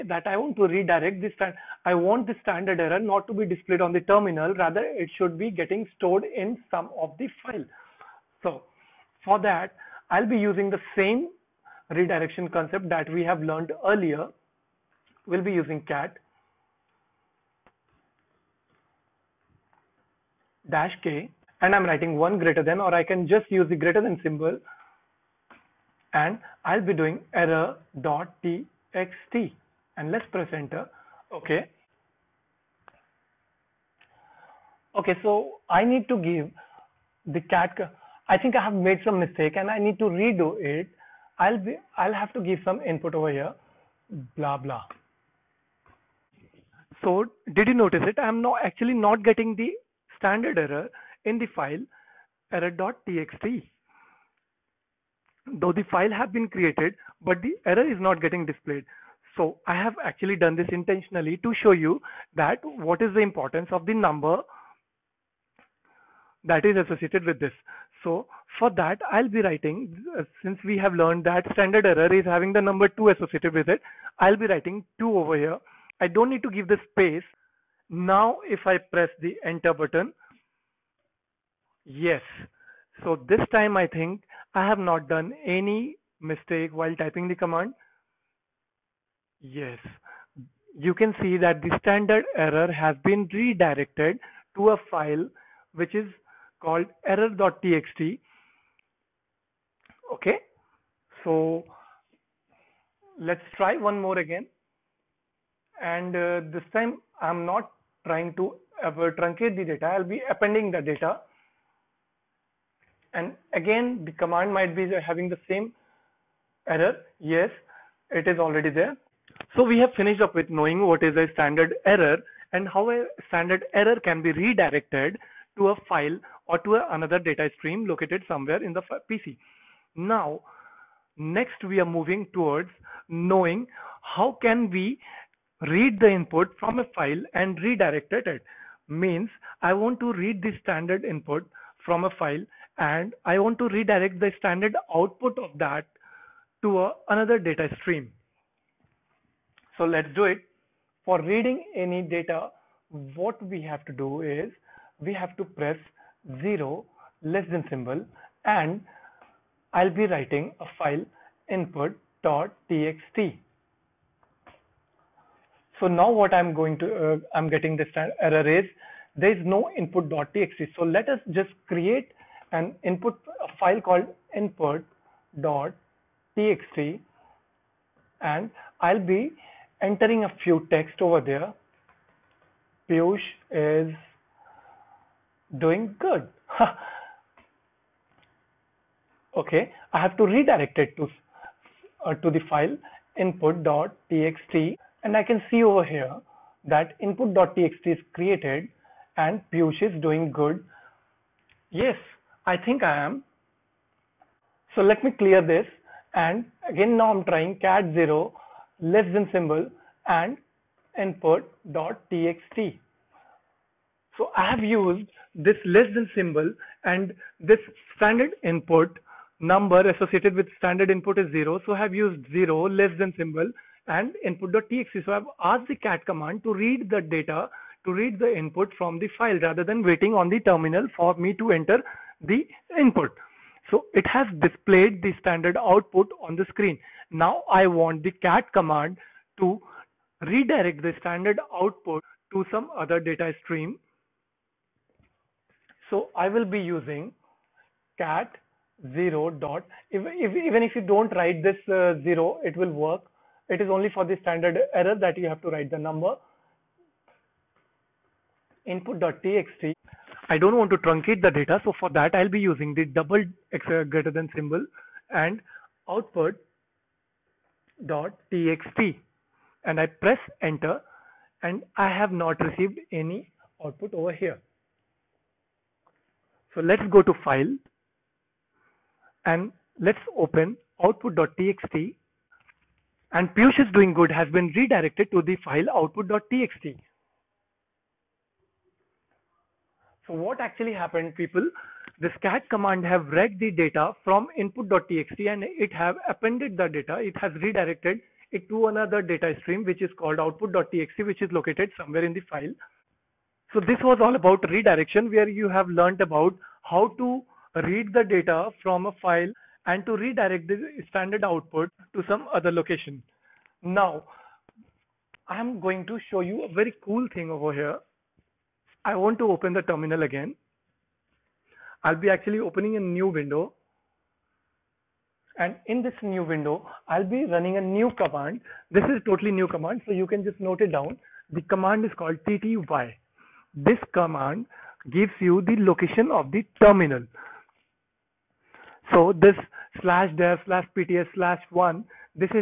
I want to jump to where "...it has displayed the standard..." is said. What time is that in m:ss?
3:53.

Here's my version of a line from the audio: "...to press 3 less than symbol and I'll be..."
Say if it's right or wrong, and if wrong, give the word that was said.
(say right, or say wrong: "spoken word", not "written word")
wrong: "0", not "3".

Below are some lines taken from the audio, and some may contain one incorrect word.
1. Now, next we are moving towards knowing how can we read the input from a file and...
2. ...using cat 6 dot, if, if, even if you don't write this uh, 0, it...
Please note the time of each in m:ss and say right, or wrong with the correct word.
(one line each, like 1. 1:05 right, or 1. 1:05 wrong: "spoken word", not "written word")
1. 2:09 right
2. 4:06 wrong: "0", not "6".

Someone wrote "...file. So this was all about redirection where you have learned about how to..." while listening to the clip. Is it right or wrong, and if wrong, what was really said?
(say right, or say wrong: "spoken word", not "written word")
right.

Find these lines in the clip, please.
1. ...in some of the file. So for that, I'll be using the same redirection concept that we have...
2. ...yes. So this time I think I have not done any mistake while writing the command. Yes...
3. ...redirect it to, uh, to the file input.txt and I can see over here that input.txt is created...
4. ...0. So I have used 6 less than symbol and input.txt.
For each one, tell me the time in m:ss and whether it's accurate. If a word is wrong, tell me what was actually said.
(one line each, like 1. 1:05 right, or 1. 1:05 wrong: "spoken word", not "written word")
1. 0:06 right
2. 1:21 wrong: "typing", not "writing"
3. 3:10 right
4. 3:41 wrong: "0", not "6".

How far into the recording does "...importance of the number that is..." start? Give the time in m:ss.
1:03.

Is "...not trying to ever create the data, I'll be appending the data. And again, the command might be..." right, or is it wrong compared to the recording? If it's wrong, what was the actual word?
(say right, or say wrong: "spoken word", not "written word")
wrong: "truncate", not "create".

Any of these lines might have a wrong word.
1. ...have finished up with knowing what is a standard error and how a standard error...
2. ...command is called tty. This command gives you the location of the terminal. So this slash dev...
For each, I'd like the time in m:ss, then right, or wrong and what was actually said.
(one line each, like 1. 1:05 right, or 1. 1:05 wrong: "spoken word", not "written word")
1. 1:59 right
2. 5:31 right.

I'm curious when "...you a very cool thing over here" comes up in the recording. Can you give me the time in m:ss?
5:16.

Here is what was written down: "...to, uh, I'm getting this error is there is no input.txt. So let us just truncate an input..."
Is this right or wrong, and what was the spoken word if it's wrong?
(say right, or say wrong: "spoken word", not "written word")
wrong: "create", not "truncate".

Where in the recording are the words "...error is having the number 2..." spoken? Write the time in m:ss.
1:11.